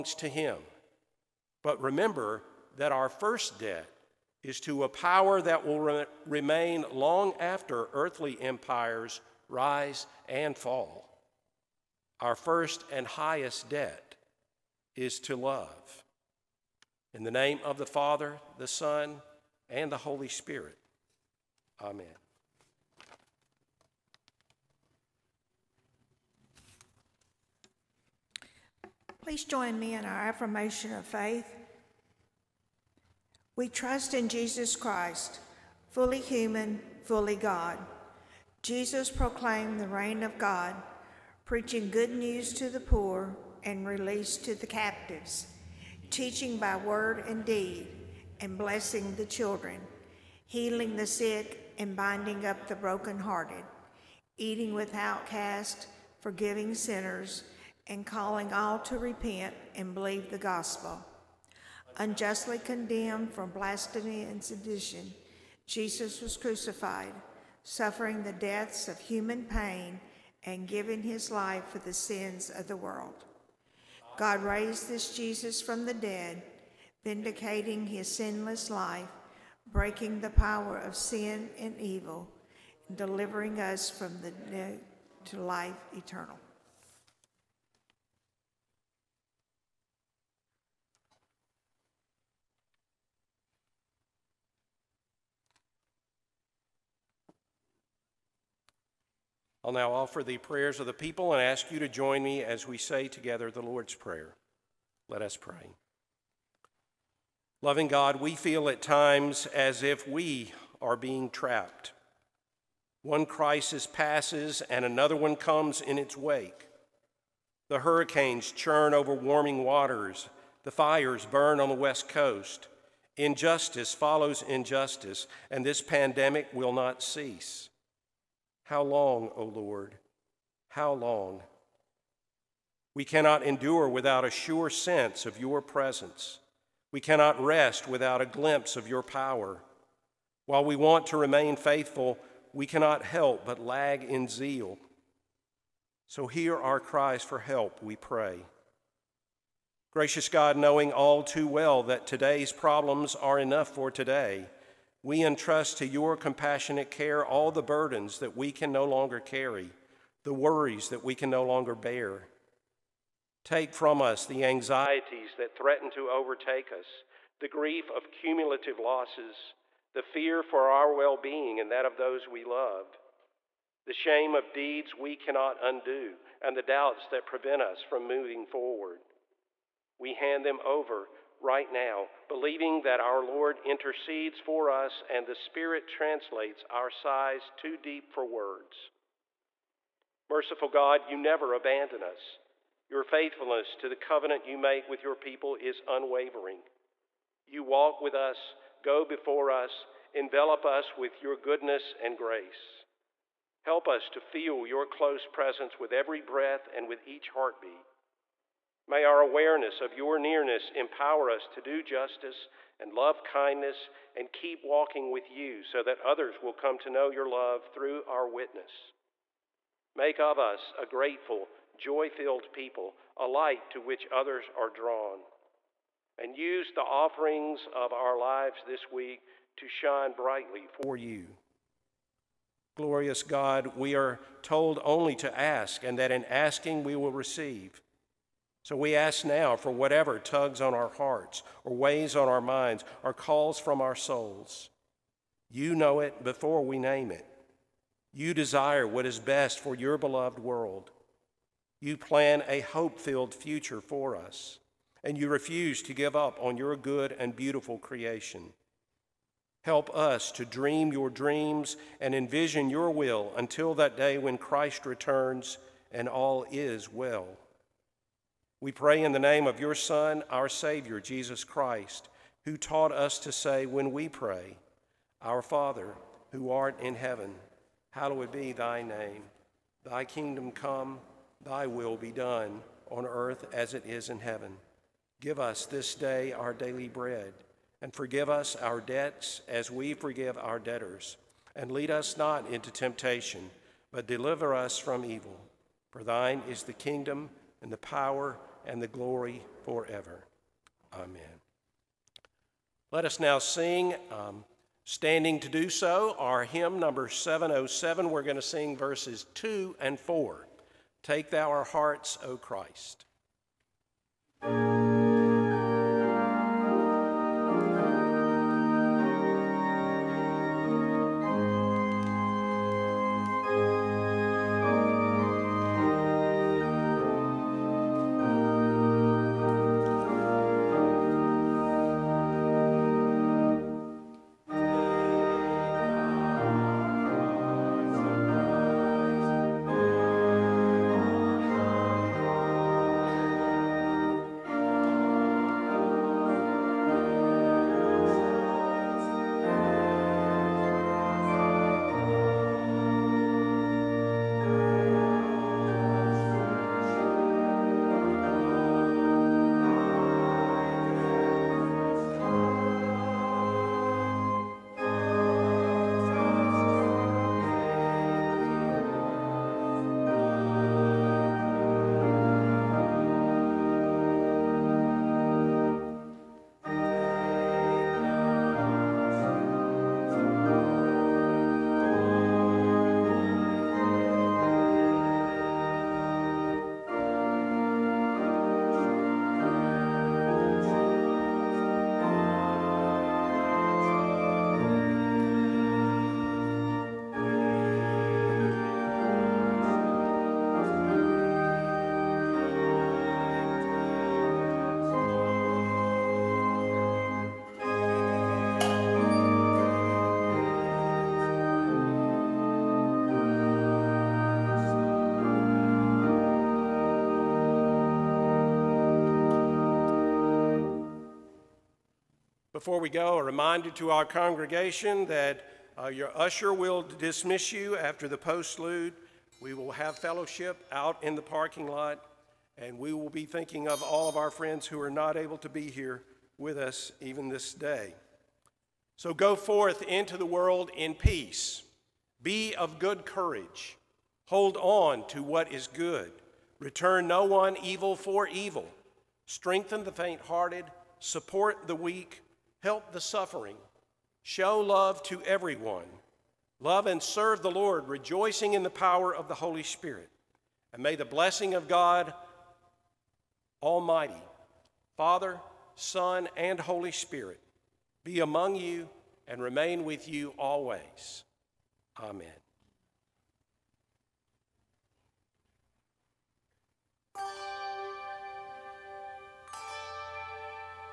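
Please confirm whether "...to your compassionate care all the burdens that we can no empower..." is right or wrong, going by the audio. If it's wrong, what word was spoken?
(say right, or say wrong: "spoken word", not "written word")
wrong: "longer", not "empower".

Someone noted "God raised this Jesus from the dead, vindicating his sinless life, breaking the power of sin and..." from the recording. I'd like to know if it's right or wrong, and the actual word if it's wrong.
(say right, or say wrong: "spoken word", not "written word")
right.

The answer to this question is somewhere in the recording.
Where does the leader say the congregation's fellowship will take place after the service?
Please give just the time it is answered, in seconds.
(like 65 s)
431 s.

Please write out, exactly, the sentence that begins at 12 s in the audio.
Our first and highest debt is to love.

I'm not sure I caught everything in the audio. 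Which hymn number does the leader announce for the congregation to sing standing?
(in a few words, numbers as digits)
707.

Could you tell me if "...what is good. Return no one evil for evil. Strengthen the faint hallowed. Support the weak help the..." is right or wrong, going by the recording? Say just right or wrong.
wrong.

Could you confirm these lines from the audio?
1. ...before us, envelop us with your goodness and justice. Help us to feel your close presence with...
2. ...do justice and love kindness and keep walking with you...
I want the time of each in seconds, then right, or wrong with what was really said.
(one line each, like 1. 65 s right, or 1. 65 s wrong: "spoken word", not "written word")
1. 199 s wrong: "grace", not "justice"
2. 211 s right.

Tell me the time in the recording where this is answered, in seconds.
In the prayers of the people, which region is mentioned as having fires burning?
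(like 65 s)
121 s.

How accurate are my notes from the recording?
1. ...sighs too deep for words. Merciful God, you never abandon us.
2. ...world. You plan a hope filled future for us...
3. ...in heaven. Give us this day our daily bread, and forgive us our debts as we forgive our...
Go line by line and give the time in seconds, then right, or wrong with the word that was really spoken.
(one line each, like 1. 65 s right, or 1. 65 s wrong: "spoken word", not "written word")
1. 186 s right
2. 250 s right
3. 284 s right.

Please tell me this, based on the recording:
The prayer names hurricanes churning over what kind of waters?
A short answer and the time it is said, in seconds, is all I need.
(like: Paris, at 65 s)
Warming waters, at 119 s.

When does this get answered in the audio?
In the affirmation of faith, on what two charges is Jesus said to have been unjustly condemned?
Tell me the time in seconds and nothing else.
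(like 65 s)
63 s.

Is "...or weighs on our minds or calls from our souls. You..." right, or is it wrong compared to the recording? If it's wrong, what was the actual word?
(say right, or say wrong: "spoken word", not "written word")
right.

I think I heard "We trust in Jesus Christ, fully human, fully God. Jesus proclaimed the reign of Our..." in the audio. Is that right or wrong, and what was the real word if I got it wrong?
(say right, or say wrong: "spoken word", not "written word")
wrong: "God", not "Our".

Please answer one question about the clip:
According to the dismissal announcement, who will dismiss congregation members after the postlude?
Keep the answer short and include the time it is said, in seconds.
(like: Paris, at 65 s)
Your usher, at 426 s.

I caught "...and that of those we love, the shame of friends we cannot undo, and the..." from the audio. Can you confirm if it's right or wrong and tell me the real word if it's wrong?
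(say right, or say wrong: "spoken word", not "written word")
wrong: "deeds", not "friends".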